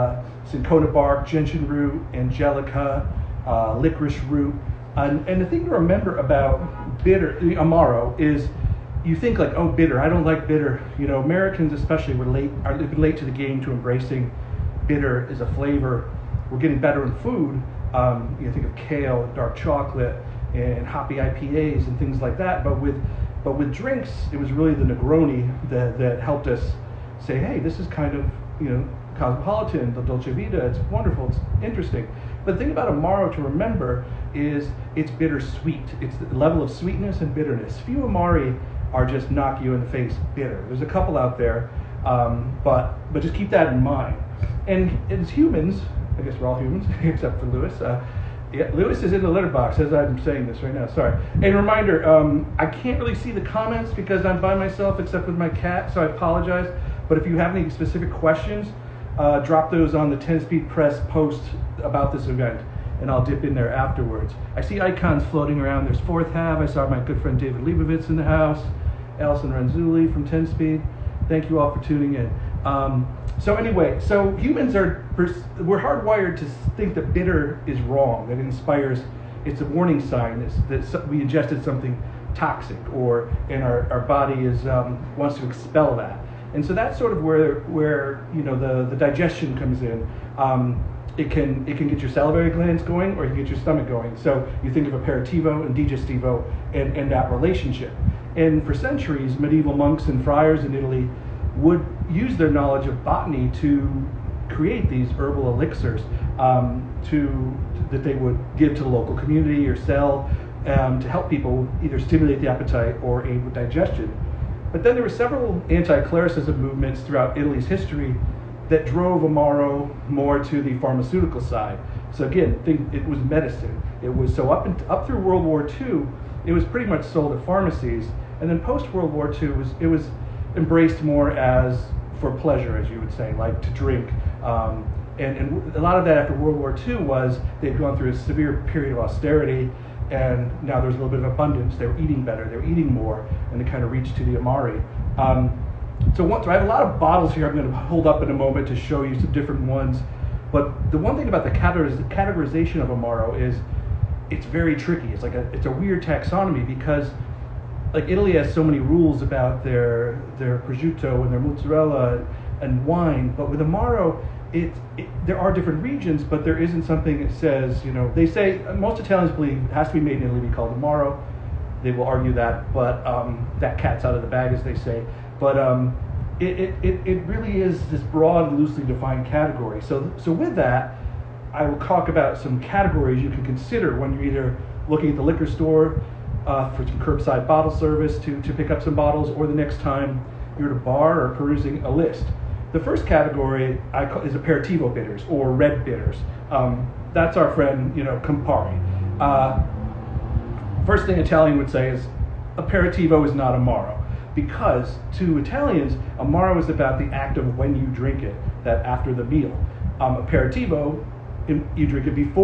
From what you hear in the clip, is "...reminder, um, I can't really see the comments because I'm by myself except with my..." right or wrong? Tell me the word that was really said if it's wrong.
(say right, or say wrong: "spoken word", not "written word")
right.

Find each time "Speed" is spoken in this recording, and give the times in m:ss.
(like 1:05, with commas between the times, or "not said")
1:00, 1:10.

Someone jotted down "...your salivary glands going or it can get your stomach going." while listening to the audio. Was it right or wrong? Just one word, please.
right.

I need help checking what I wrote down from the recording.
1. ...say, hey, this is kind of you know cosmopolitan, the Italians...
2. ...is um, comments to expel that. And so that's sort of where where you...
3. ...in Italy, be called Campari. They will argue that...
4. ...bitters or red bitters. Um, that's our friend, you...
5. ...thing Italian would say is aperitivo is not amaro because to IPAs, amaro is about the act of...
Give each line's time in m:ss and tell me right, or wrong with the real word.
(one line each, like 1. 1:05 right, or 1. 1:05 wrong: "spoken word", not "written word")
1. 0:27 wrong: "Dolce", not "Italians"
2. 1:24 wrong: "wants", not "comments"
3. 2:50 wrong: "Amaro", not "Campari"
4. 3:14 right
5. 3:21 wrong: "Italians", not "IPAs".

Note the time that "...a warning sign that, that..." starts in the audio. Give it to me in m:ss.
1:19.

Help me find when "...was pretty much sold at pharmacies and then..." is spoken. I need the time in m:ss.
2:06.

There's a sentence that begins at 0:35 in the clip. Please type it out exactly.
It's the level of sweetness and bitterness.